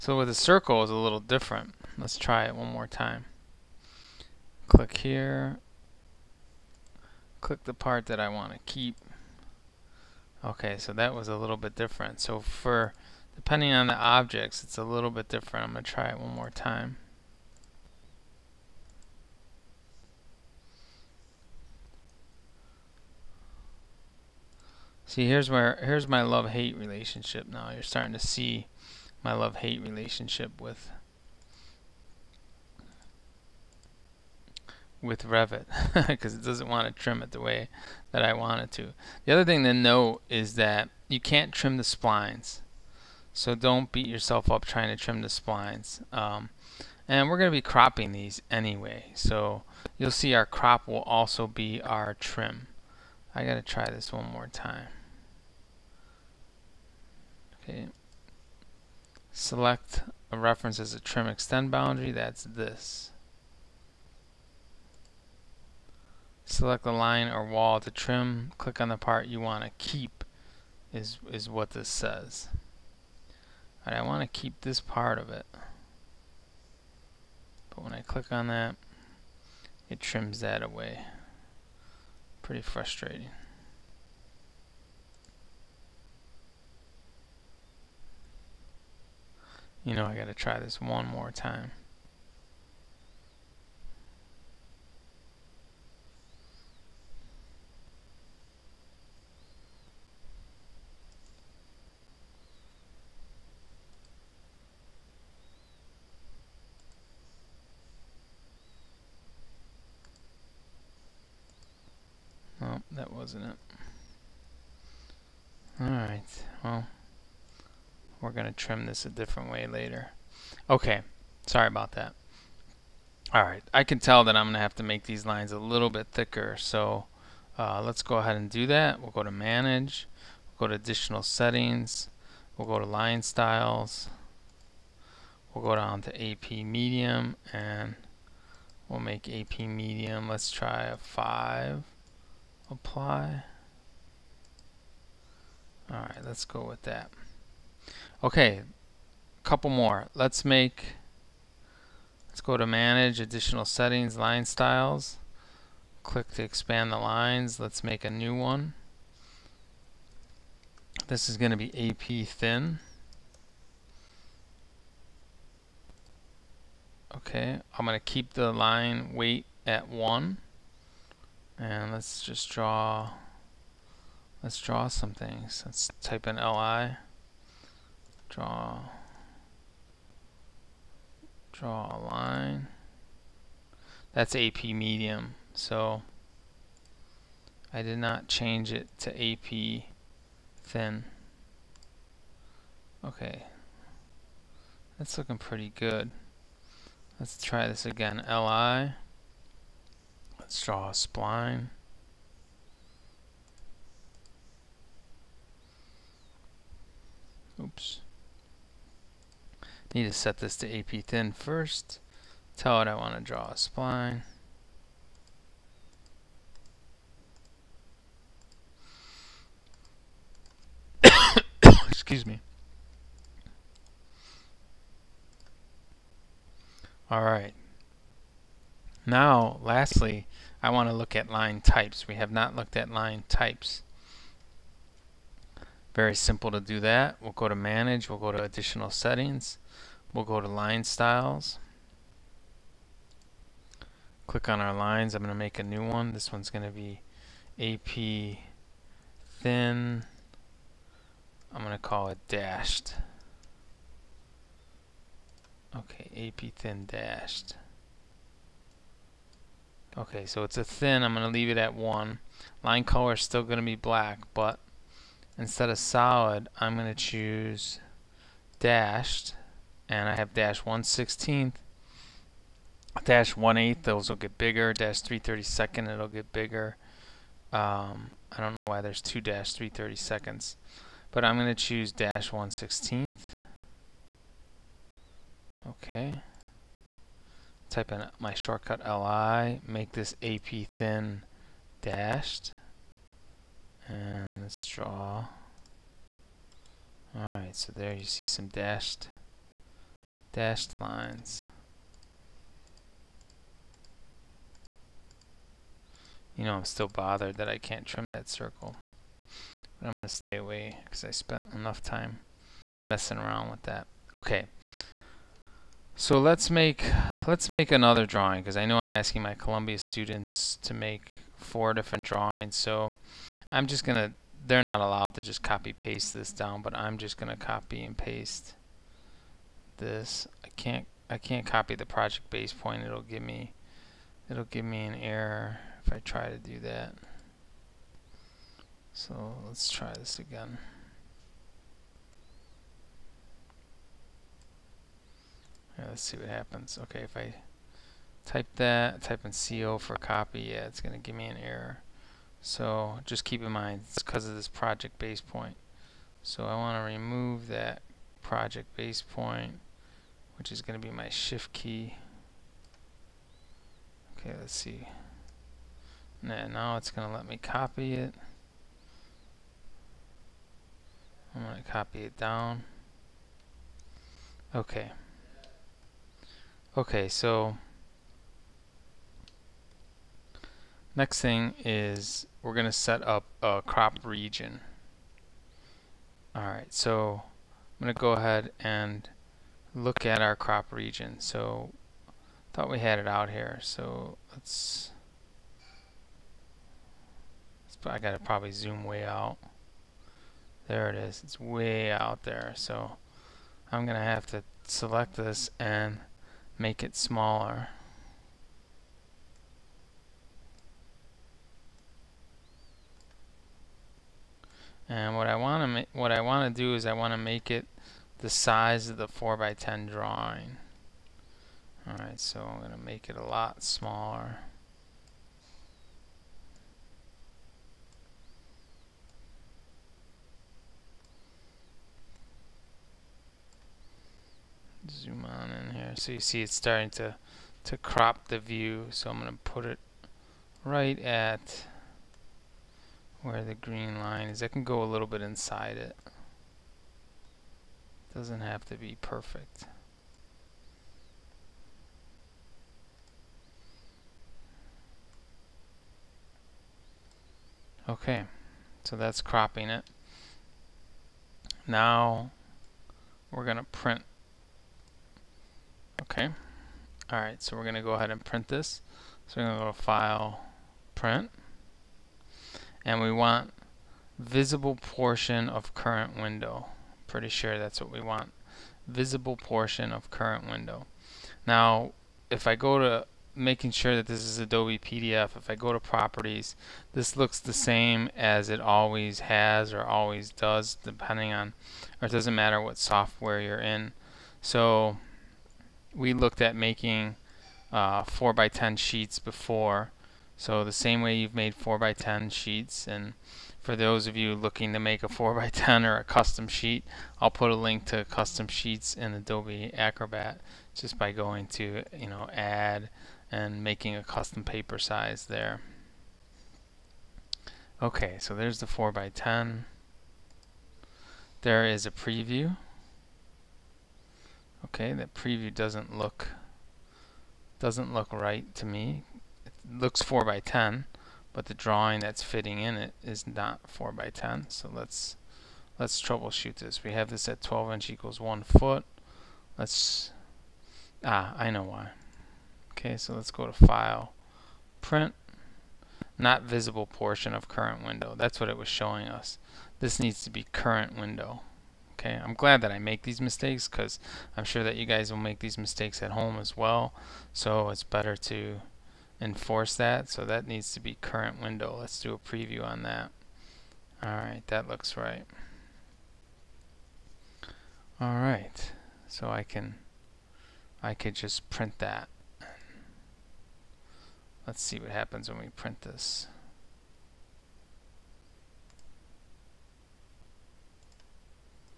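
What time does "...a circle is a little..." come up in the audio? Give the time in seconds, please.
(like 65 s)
0 s.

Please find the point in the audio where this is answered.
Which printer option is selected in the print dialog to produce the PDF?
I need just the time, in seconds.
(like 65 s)
484 s.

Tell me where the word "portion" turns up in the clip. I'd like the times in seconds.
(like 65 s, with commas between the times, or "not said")
474 s, 479 s, 546 s.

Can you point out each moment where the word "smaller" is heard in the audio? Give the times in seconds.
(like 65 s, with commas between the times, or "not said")
406 s, 423 s.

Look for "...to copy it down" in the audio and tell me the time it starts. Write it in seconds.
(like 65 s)
371 s.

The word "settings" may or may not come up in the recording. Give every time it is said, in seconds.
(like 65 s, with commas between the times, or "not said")
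131 s, 153 s, 238 s.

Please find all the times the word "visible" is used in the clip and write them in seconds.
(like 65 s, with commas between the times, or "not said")
474 s, 478 s, 546 s.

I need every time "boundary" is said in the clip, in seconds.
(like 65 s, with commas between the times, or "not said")
61 s.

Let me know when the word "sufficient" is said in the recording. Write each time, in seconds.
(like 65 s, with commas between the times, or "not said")
not said.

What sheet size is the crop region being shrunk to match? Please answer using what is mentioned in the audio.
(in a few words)
4x10.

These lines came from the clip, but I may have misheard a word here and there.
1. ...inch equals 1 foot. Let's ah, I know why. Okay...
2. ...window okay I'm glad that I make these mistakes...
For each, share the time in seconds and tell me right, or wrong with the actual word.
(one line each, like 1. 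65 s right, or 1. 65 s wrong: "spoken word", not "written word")
1. 537 s right
2. 550 s right.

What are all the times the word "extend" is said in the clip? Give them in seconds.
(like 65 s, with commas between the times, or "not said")
61 s.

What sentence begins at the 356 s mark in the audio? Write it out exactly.
So I want to remove that project base point, which is going to be my shift key.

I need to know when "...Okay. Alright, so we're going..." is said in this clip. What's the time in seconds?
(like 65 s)
466 s.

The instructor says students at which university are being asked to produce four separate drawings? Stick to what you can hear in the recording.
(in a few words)
Columbia.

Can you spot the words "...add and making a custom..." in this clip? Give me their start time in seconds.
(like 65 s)
512 s.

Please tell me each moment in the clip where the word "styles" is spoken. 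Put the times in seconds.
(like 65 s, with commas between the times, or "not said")
133 s, 154 s, 240 s.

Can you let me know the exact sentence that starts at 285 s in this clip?
Okay type in my shortcut li, make this AP thin dashed, and let's draw.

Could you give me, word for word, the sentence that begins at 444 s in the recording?
I can go a little bit inside it.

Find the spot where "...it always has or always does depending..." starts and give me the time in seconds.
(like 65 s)
488 s.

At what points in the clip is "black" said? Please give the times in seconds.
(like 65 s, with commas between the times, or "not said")
263 s.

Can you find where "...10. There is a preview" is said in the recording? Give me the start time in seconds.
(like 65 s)
519 s.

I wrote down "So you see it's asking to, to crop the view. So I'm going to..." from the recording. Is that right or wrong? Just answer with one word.
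wrong.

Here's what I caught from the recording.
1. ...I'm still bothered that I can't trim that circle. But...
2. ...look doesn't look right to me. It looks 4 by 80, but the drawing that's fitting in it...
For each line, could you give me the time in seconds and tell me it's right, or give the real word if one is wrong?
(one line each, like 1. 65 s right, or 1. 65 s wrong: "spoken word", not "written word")
1. 306 s right
2. 525 s wrong: "10", not "80".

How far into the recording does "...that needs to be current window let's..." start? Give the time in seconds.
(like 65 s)
560 s.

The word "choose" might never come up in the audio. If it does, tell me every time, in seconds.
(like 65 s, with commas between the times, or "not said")
266 s, 281 s.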